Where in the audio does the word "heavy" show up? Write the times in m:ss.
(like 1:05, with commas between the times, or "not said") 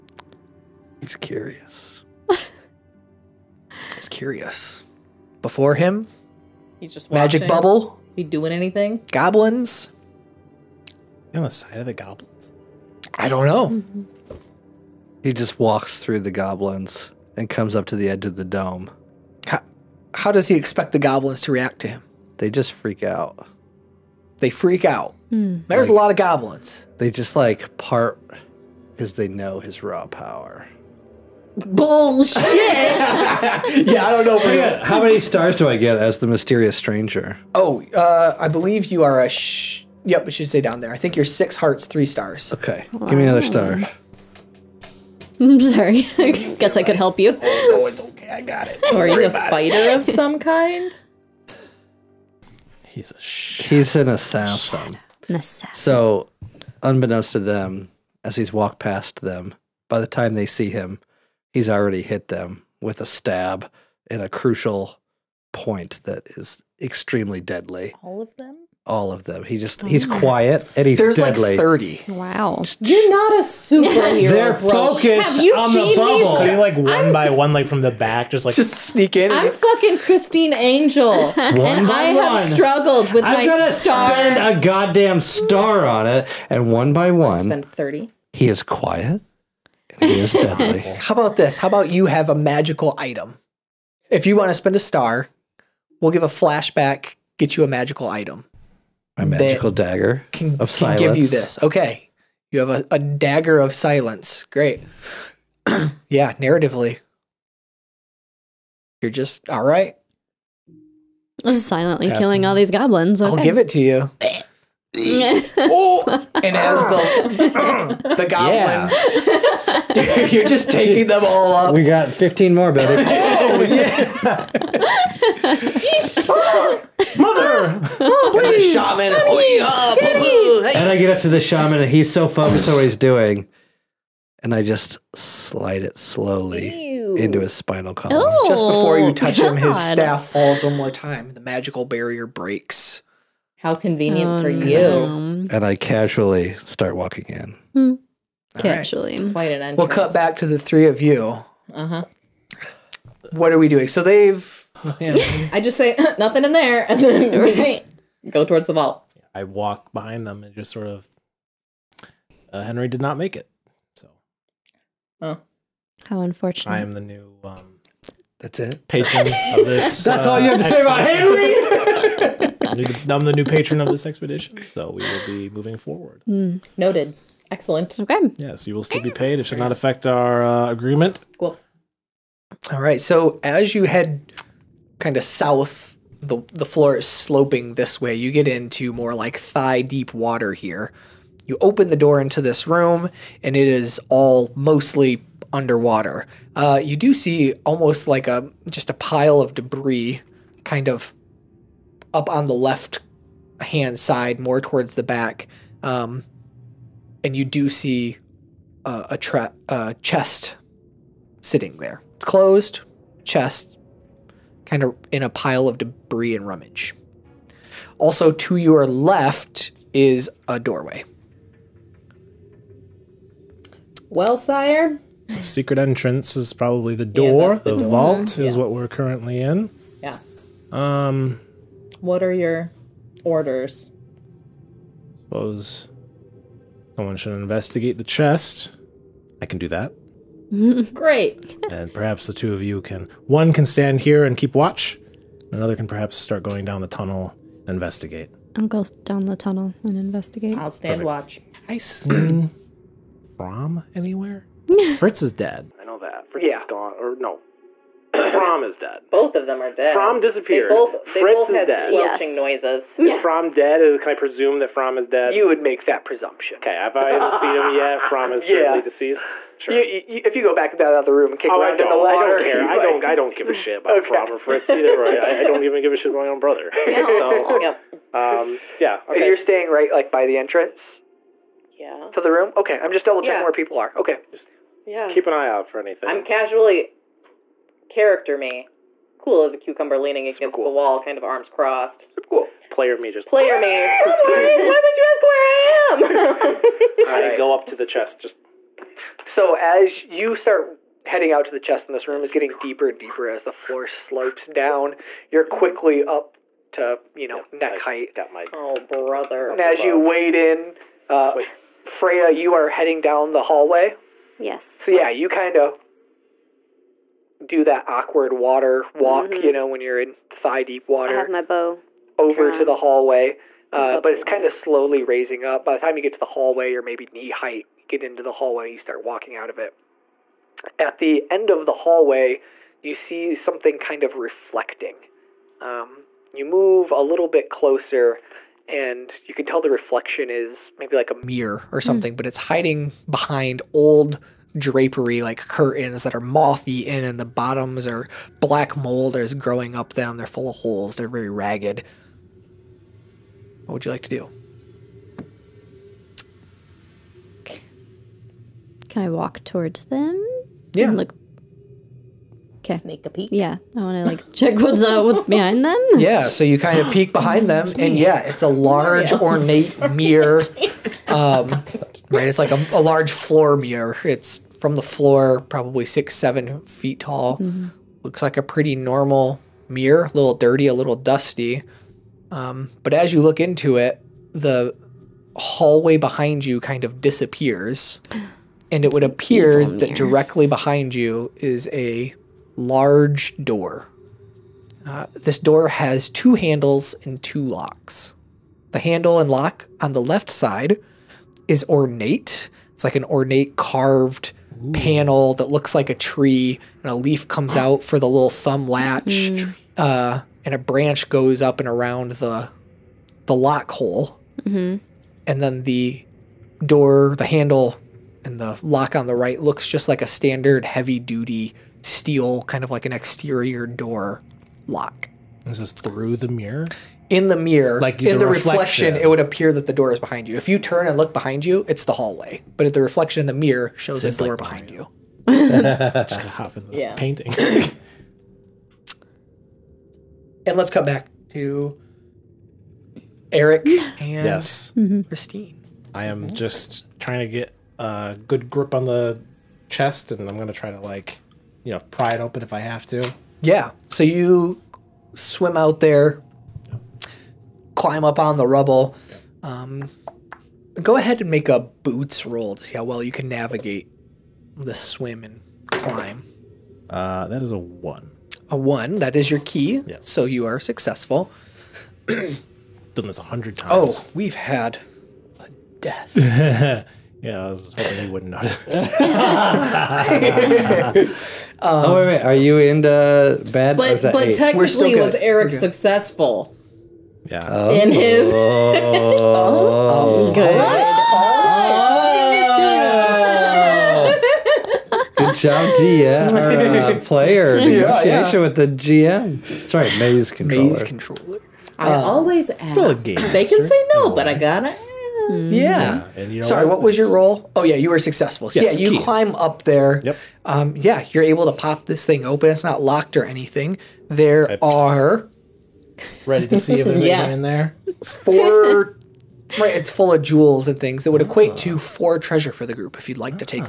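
7:00.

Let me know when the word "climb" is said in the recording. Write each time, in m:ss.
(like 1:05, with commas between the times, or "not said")
7:37, 7:45, 8:29.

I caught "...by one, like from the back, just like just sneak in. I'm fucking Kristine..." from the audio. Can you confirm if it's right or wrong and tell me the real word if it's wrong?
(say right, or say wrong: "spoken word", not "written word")
right.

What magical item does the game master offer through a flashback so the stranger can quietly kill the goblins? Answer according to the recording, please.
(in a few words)
Dagger of silence.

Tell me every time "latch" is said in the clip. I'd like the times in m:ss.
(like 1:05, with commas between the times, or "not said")
6:48.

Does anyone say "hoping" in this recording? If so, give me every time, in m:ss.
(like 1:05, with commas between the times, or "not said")
7:57.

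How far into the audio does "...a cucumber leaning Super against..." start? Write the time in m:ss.
4:49.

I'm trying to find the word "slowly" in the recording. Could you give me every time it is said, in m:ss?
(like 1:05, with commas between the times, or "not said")
2:15, 5:24.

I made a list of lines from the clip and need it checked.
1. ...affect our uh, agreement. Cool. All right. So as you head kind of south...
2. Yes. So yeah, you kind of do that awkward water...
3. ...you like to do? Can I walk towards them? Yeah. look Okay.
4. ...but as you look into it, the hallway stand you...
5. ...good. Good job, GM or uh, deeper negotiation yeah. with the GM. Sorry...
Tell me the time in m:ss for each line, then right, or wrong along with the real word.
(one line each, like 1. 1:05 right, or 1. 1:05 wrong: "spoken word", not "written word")
1. 2:59 right
2. 5:14 right
3. 5:53 right
4. 6:22 wrong: "behind", not "stand"
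5. 8:10 wrong: "player", not "deeper".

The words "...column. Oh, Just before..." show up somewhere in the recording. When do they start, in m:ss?
2:17.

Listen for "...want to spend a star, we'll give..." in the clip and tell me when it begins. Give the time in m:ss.
1:34.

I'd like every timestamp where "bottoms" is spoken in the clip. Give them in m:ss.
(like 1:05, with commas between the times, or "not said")
5:47.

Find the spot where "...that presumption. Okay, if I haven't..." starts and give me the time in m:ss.
4:25.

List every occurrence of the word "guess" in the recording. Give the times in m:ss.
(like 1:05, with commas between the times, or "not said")
0:46.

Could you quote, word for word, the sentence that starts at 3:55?
Suppose someone should investigate the chest.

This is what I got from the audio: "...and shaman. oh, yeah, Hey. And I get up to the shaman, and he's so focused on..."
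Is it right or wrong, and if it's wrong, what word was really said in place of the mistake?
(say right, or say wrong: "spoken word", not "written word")
right.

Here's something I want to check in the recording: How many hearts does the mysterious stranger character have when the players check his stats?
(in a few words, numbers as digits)
6.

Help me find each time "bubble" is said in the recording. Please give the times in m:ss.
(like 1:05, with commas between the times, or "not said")
0:07, 1:16.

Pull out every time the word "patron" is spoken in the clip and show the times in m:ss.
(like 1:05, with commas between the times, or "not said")
2:48, 2:53.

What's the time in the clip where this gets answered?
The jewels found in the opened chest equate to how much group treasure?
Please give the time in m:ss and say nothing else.
8:41.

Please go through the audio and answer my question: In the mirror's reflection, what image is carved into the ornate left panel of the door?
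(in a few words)
A tree.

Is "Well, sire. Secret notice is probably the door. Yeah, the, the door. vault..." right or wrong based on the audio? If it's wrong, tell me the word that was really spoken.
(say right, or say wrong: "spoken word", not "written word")
wrong: "entrance", not "notice".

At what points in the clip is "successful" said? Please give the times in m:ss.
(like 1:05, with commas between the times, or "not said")
7:50, 8:05, 8:27.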